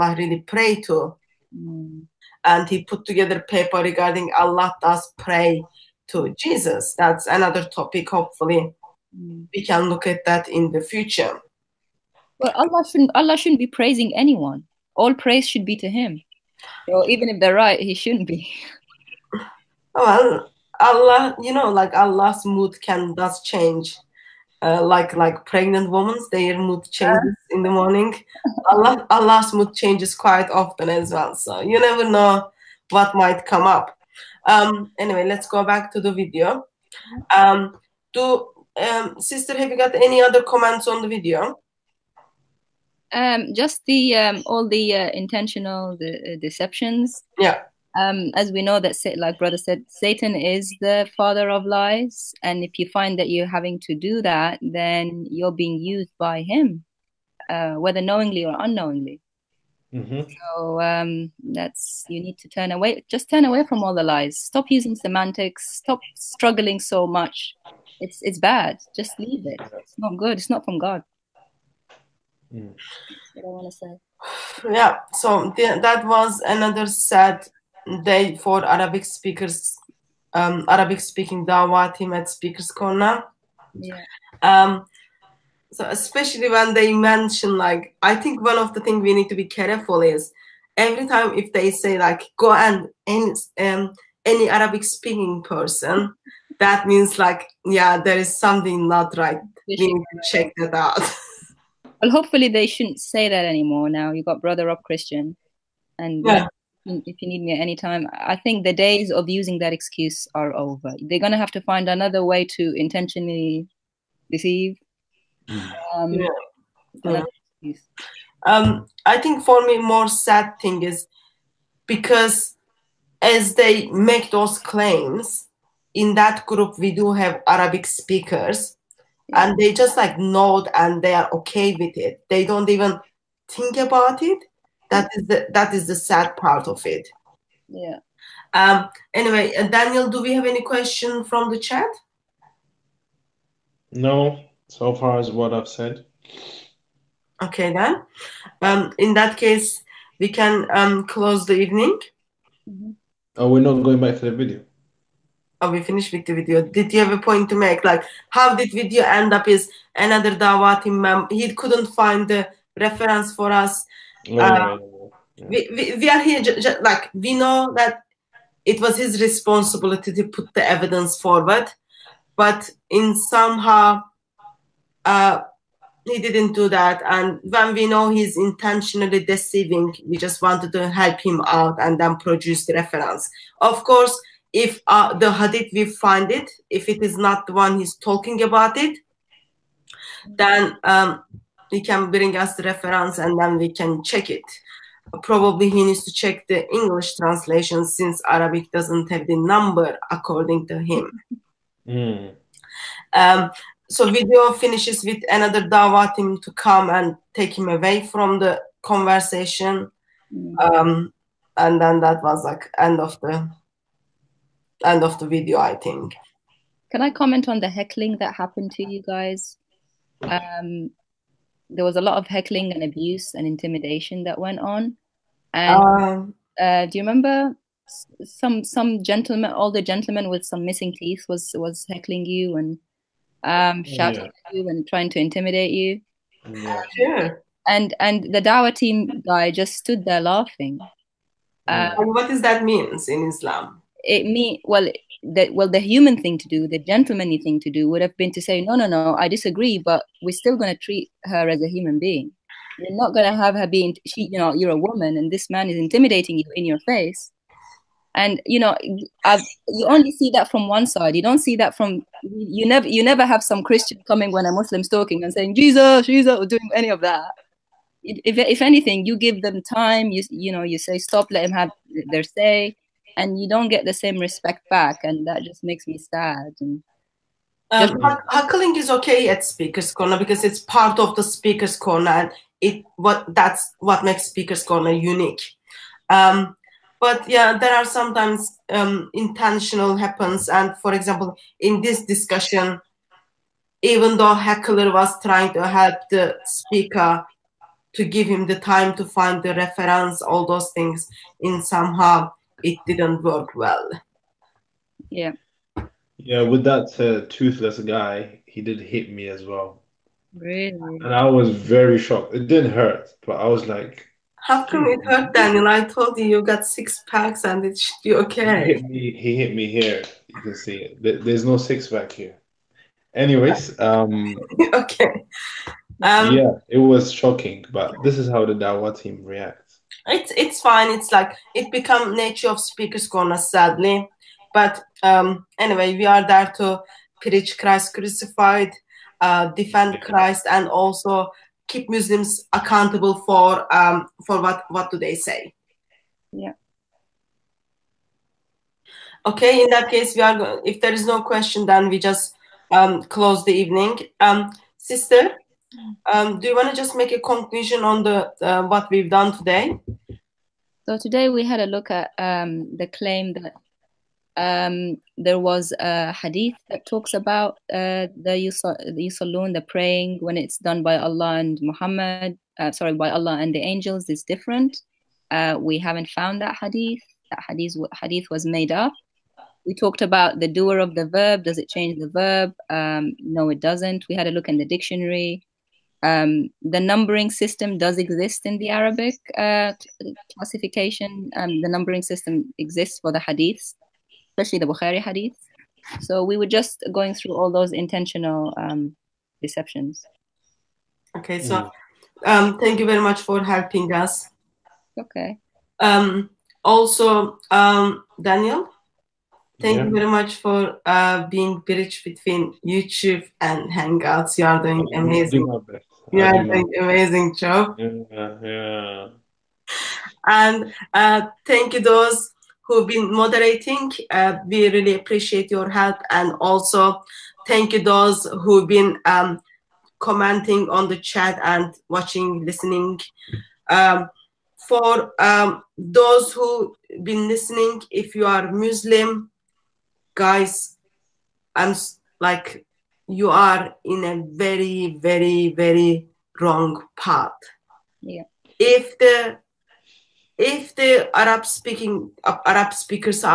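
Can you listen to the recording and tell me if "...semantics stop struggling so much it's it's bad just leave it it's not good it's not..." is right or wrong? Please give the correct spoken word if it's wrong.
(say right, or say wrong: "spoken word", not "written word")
right.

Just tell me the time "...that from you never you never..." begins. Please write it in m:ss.
4:21.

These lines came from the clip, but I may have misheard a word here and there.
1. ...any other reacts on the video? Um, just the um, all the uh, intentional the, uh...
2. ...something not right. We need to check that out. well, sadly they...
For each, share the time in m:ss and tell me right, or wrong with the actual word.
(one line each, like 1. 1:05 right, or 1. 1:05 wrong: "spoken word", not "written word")
1. 0:39 wrong: "comments", not "reacts"
2. 1:38 wrong: "hopefully", not "sadly".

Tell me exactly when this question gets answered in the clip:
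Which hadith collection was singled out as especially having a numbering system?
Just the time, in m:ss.
6:34.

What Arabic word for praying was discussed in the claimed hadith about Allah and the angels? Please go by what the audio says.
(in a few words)
yusallun.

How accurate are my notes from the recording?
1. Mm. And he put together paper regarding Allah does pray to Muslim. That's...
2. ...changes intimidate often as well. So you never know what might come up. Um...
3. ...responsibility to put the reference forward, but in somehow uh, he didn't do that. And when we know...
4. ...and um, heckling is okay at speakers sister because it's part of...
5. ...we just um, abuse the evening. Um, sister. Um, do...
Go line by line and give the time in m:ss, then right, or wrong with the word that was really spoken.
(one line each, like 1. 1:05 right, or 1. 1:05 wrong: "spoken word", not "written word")
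1. 0:01 wrong: "Jesus", not "Muslim"
2. 0:29 wrong: "quite", not "intimidate"
3. 2:49 wrong: "evidence", not "reference"
4. 4:36 wrong: "corner", not "sister"
5. 5:51 wrong: "close", not "abuse".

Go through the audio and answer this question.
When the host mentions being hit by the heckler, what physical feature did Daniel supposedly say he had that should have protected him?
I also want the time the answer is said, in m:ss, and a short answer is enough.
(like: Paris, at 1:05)
six packs, at 5:16.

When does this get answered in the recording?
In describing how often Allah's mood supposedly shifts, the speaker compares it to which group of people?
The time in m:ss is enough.
0:25.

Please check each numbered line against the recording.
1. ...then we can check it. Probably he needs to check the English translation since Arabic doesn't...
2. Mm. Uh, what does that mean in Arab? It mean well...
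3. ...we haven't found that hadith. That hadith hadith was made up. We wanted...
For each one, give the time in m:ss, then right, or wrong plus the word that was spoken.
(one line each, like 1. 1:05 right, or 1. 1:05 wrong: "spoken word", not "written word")
1. 3:13 right
2. 4:01 wrong: "Islam", not "Arab"
3. 6:15 wrong: "talked", not "wanted".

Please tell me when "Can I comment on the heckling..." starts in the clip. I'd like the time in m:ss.
3:36.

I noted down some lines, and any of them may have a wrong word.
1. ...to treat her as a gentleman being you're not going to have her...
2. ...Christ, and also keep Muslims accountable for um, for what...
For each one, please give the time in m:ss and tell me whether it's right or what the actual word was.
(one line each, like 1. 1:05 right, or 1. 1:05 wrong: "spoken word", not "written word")
1. 4:10 wrong: "human", not "gentleman"
2. 5:40 right.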